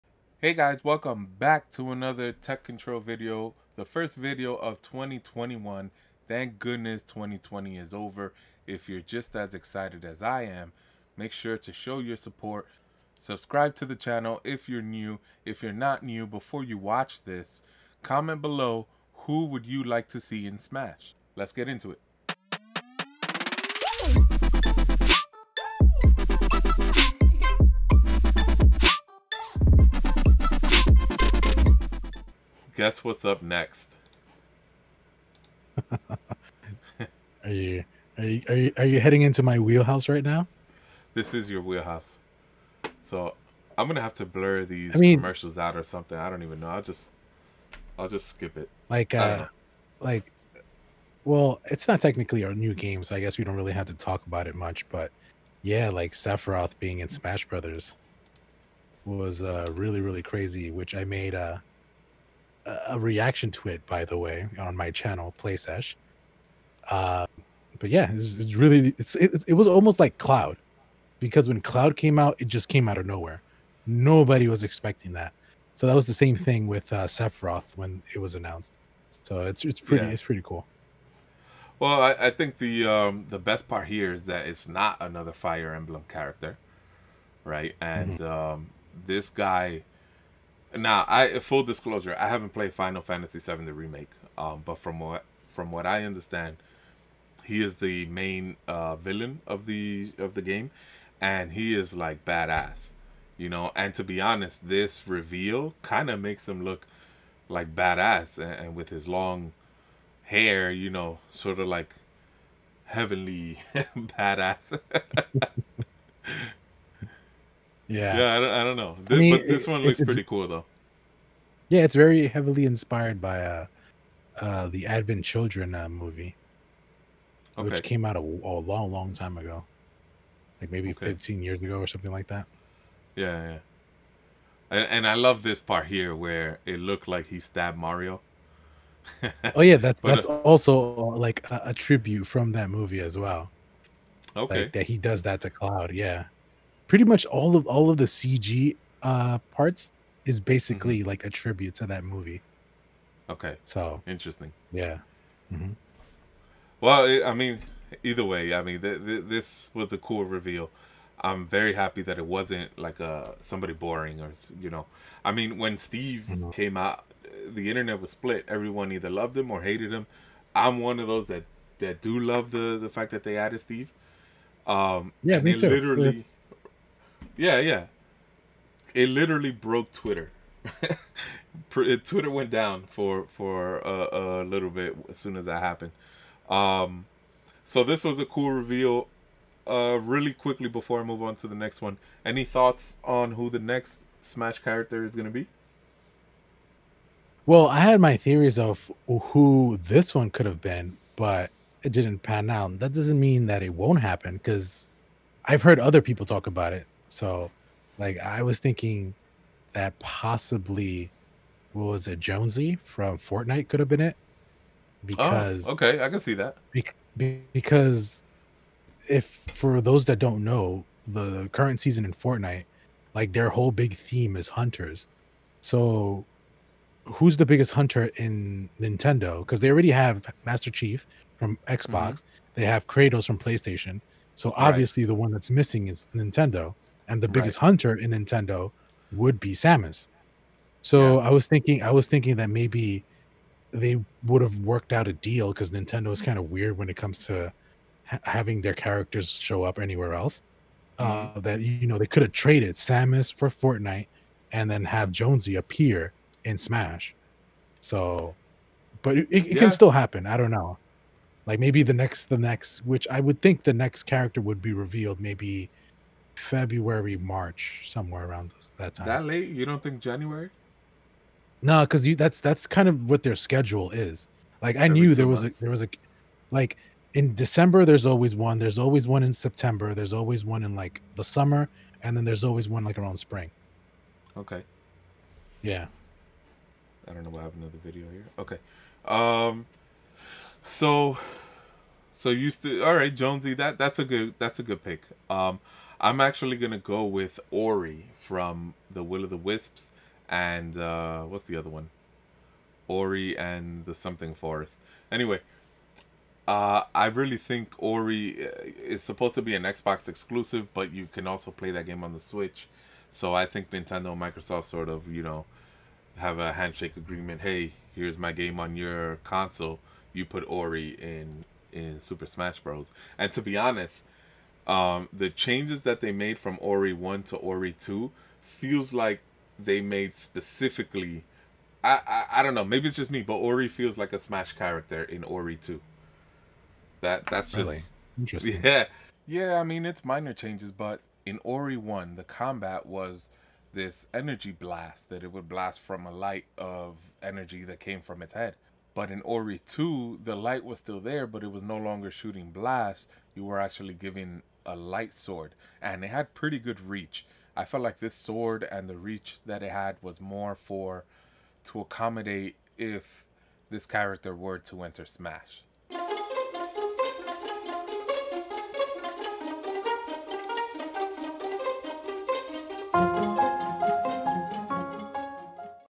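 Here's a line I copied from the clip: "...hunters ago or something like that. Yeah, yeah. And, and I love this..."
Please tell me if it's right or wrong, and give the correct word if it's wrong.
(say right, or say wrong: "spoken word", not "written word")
wrong: "years", not "hunters".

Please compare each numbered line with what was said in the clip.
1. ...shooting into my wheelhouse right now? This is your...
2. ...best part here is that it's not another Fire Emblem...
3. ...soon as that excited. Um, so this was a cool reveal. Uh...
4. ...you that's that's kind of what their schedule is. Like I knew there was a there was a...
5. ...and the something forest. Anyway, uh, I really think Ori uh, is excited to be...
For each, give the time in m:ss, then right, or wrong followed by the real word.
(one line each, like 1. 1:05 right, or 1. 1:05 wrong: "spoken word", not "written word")
1. 0:38 wrong: "heading", not "shooting"
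2. 1:23 right
3. 3:05 wrong: "happened", not "excited"
4. 4:32 right
5. 5:03 wrong: "supposed", not "excited".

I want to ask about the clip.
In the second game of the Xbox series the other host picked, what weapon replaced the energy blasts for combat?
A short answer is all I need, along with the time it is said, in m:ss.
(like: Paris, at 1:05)
light sword, at 5:54.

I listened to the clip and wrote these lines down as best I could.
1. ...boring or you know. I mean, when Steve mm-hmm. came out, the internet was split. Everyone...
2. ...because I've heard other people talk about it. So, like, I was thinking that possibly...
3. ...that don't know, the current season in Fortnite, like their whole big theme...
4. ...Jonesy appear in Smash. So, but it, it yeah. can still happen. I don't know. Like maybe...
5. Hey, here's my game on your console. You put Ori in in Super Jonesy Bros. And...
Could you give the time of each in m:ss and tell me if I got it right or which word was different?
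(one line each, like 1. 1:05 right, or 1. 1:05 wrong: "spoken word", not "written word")
1. 2:43 right
2. 3:24 right
3. 3:40 right
4. 4:15 right
5. 5:17 wrong: "Smash", not "Jonesy".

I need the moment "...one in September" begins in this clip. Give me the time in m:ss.
4:39.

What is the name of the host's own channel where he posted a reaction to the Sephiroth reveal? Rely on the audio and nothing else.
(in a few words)
Playsesh.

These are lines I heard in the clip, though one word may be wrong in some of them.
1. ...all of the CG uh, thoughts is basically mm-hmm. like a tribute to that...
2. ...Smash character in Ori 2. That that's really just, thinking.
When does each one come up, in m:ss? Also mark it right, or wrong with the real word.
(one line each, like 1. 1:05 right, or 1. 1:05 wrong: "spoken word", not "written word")
1. 2:27 wrong: "parts", not "thoughts"
2. 5:34 wrong: "interesting", not "thinking".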